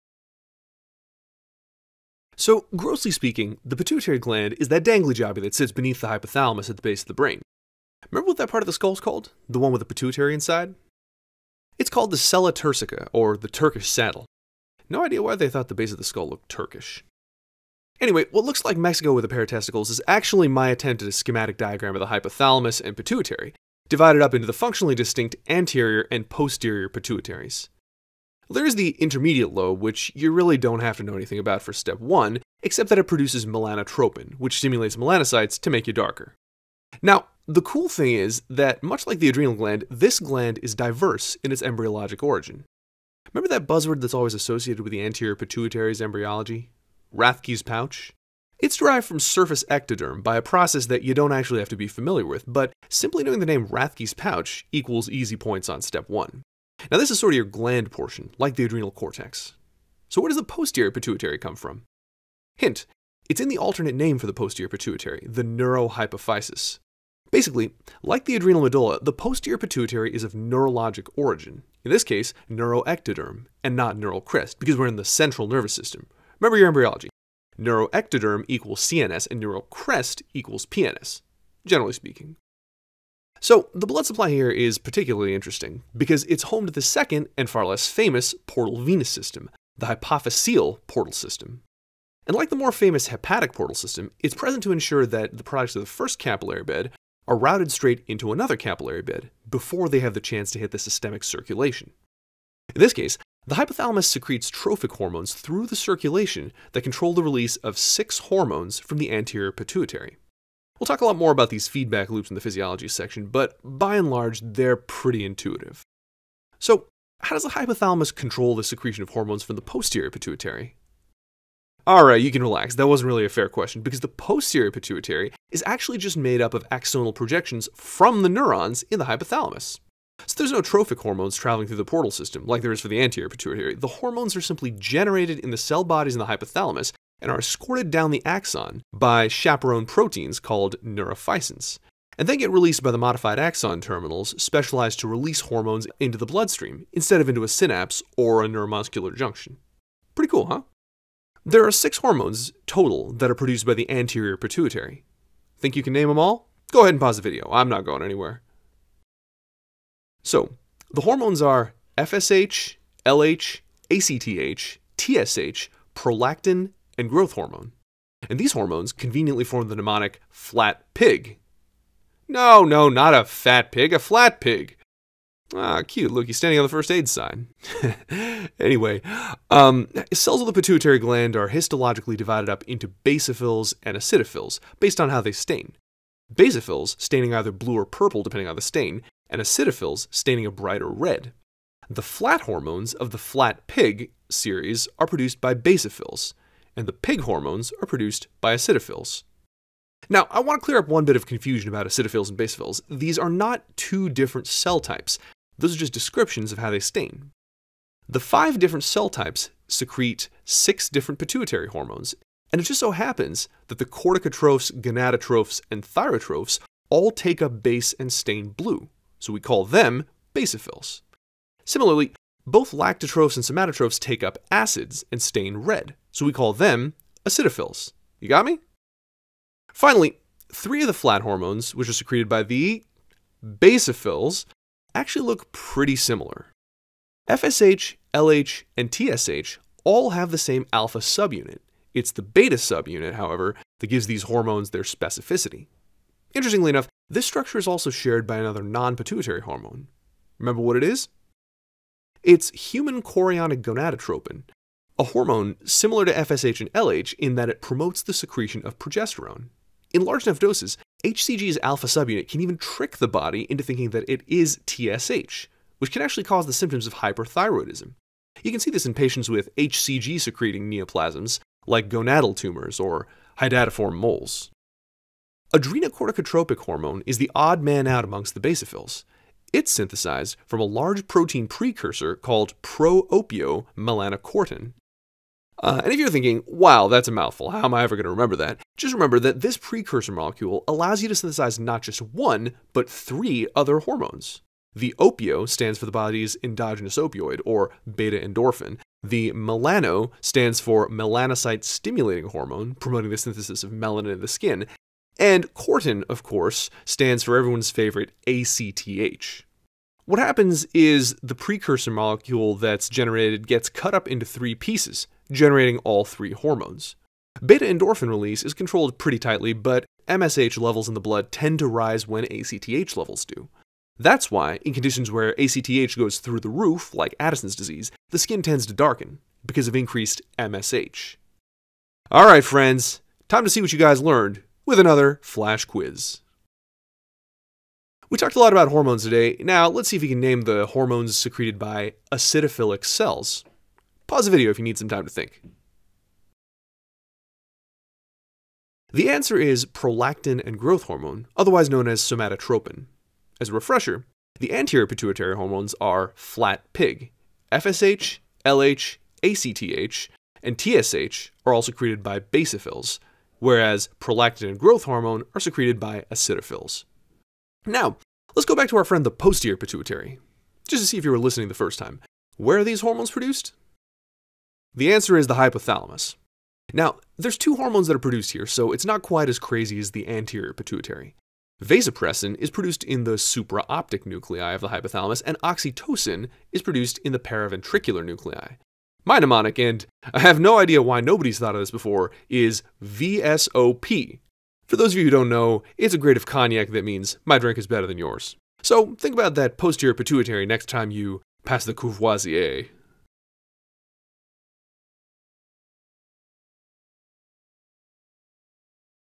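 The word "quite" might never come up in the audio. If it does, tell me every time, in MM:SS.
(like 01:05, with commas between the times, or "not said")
06:19.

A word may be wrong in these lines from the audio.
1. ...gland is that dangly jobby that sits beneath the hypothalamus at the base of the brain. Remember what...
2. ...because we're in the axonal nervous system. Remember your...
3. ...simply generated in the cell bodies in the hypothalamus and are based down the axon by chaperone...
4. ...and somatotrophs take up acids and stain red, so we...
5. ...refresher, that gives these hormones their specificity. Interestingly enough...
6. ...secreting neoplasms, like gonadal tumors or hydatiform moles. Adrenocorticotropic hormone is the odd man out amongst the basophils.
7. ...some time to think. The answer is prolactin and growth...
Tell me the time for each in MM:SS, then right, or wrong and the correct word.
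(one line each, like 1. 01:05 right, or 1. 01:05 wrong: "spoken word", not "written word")
1. 00:04 right
2. 01:14 wrong: "central", not "axonal"
3. 02:14 wrong: "escorted", not "based"
4. 03:43 right
5. 04:03 wrong: "however", not "refresher"
6. 04:30 right
7. 05:44 right.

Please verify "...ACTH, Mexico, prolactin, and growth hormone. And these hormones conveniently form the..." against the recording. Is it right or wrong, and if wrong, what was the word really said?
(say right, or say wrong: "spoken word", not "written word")
wrong: "TSH", not "Mexico".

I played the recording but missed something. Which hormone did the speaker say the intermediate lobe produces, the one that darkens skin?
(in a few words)
Melanotropin.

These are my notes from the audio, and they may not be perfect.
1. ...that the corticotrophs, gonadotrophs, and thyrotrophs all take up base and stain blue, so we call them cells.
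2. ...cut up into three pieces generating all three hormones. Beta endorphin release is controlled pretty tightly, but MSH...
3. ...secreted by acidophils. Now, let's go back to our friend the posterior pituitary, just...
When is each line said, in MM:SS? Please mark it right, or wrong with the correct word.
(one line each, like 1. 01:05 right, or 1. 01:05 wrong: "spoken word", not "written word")
1. 03:33 wrong: "basophils", not "cells"
2. 05:13 right
3. 06:05 right.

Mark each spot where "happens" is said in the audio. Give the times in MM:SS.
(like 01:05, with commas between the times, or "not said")
03:32, 05:10.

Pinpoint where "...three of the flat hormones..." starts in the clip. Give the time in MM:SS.
03:50.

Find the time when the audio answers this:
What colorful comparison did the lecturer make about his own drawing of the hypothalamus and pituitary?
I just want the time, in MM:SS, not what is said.
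00:18.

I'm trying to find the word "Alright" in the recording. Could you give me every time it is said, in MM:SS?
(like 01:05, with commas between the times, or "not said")
02:01, 05:32.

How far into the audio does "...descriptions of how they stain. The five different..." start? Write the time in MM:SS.
03:25.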